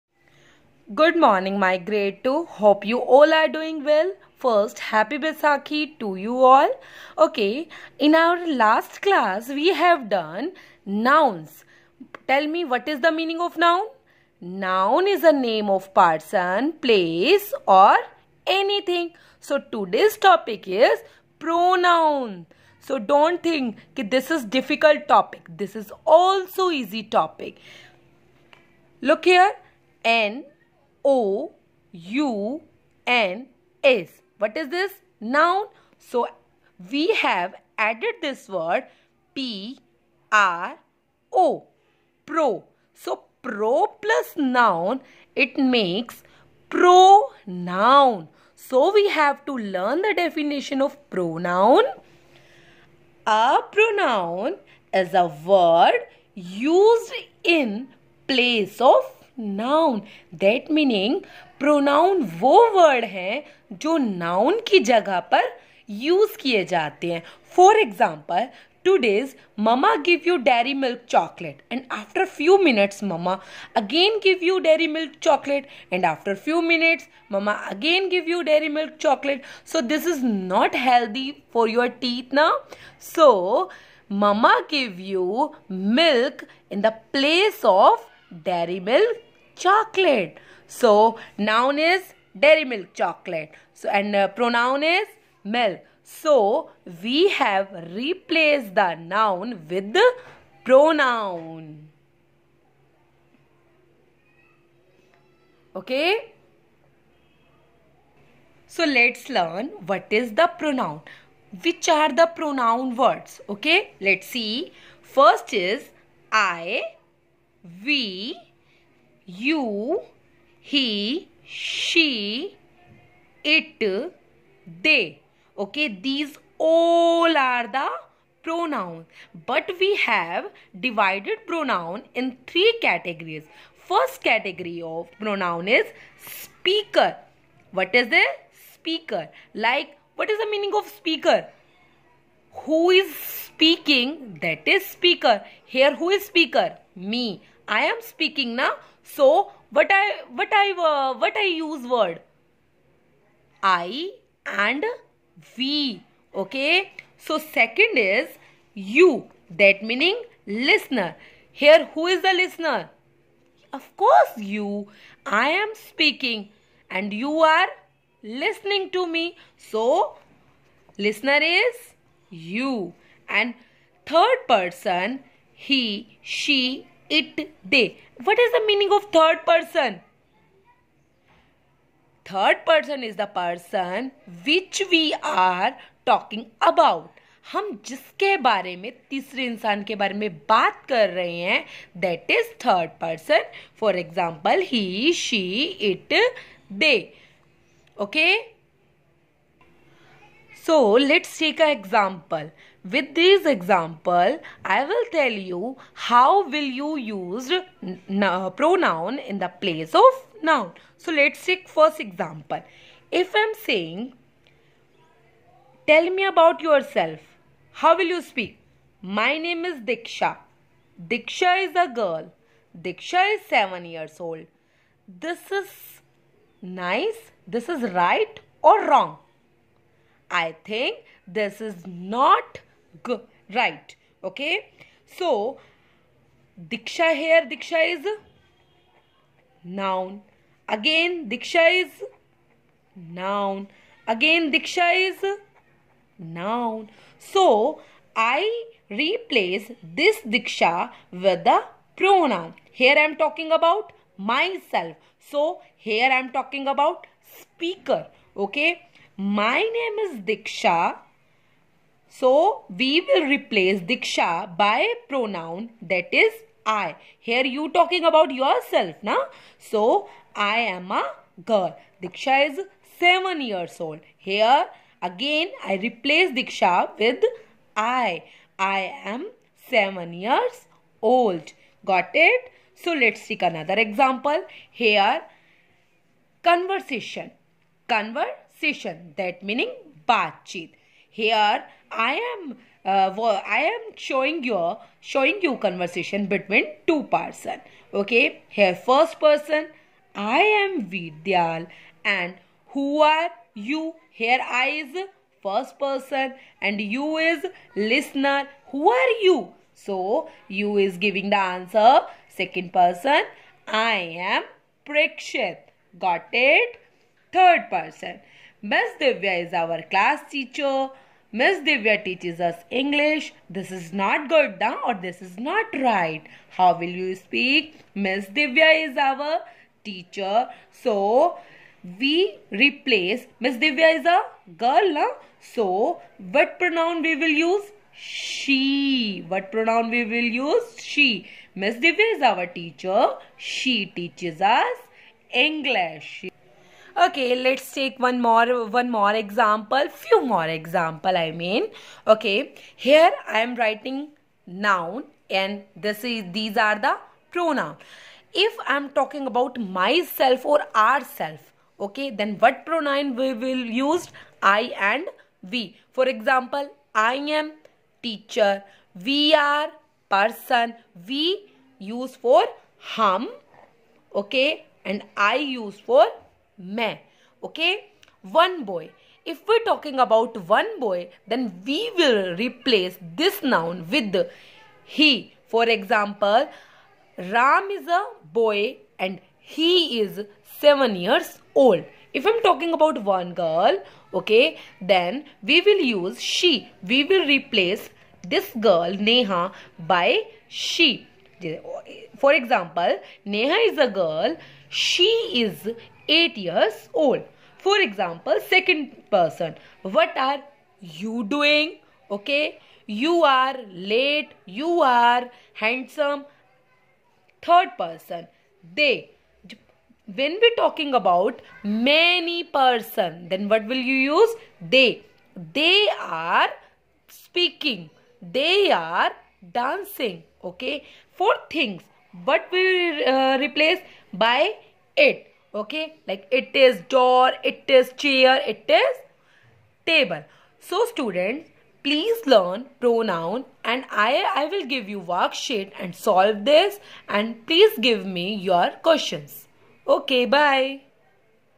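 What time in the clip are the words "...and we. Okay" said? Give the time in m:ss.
2:34.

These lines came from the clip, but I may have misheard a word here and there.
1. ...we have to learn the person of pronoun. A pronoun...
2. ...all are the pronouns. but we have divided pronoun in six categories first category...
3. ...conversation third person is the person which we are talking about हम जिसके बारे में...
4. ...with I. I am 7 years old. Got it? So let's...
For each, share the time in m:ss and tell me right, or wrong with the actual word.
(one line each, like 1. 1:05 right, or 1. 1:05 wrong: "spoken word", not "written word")
1. 0:48 wrong: "definition", not "person"
2. 2:06 wrong: "three", not "six"
3. 2:59 wrong: "person", not "conversation"
4. 4:36 right.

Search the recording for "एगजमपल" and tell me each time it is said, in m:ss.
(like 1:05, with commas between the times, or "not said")
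1:07, 3:13.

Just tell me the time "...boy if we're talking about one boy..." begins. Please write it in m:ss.
6:18.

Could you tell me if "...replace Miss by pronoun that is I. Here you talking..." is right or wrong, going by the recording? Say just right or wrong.
wrong.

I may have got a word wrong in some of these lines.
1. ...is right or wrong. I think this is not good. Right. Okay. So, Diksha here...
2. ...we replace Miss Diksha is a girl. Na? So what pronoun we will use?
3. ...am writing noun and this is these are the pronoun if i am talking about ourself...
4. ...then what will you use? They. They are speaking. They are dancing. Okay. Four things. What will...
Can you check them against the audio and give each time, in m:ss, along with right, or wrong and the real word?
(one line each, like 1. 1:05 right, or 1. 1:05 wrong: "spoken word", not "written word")
1. 3:47 right
2. 5:31 wrong: "Divya", not "Diksha"
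3. 5:53 wrong: "myself", not "ourself"
4. 7:03 right.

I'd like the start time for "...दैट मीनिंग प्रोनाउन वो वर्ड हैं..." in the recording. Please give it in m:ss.
1:00.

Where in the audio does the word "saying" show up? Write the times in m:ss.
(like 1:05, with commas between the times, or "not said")
3:33.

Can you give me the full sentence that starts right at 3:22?
With this example, I will tell you how will you use uh, pronoun in the place of noun.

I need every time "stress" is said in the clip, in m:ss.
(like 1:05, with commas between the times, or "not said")
not said.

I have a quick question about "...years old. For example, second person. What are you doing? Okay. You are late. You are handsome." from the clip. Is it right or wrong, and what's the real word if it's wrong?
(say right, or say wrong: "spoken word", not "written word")
right.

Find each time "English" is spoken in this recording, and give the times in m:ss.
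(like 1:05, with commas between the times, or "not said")
5:22, 5:45.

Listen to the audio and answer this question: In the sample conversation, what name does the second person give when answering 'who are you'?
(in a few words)
Prakshit.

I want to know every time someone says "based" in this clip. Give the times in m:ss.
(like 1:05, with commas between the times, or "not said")
not said.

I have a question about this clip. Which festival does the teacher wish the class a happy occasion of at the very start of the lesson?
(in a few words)
Baisakhi.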